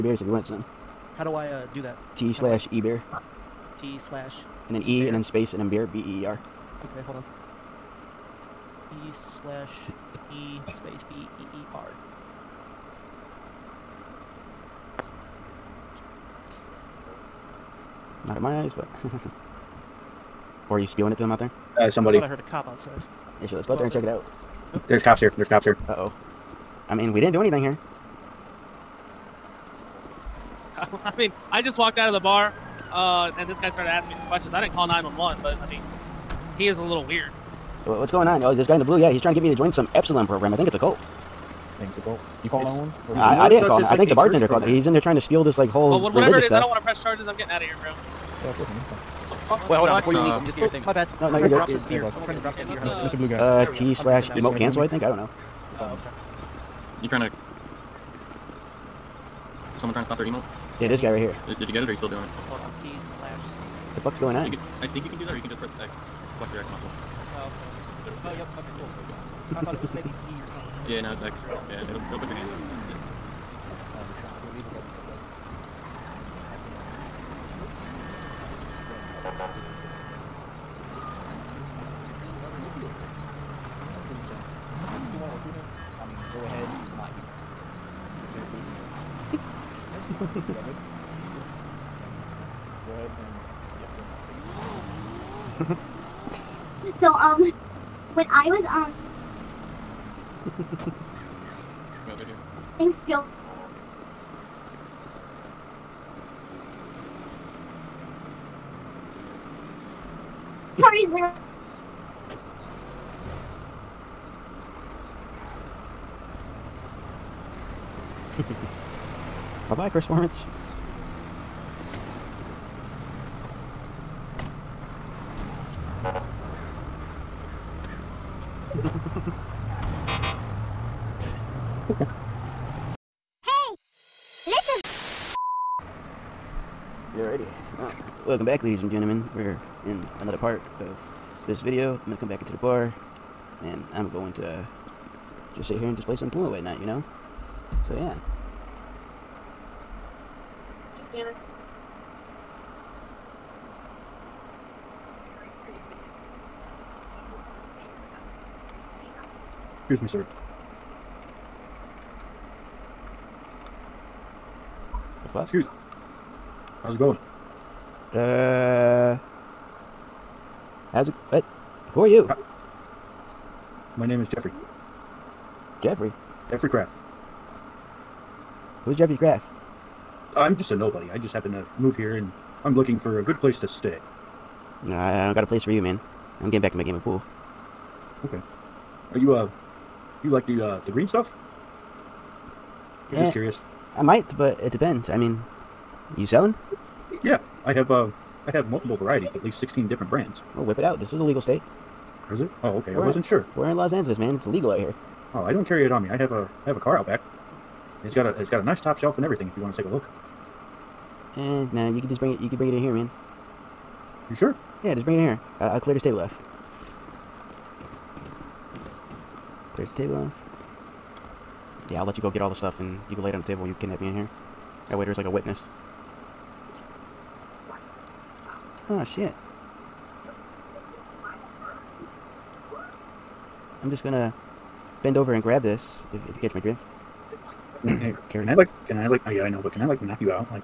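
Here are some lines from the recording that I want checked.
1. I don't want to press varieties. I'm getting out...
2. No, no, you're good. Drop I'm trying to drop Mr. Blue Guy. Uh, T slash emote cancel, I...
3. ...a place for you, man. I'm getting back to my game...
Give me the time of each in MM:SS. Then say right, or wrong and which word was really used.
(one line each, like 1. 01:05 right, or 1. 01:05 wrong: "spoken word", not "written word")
1. 00:46 wrong: "charges", not "varieties"
2. 00:51 right
3. 03:05 right.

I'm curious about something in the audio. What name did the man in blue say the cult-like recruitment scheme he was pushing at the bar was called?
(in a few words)
Epsilon program.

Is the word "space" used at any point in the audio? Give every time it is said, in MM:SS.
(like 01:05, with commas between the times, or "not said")
00:05, 00:10.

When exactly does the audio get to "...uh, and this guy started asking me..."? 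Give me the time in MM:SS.
00:32.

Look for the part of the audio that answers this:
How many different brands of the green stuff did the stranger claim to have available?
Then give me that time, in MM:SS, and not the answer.
03:19.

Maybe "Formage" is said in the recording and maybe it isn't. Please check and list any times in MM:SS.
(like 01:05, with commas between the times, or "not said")
02:00.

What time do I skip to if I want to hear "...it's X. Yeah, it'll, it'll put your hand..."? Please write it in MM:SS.
01:11.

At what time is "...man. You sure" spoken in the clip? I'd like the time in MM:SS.
03:32.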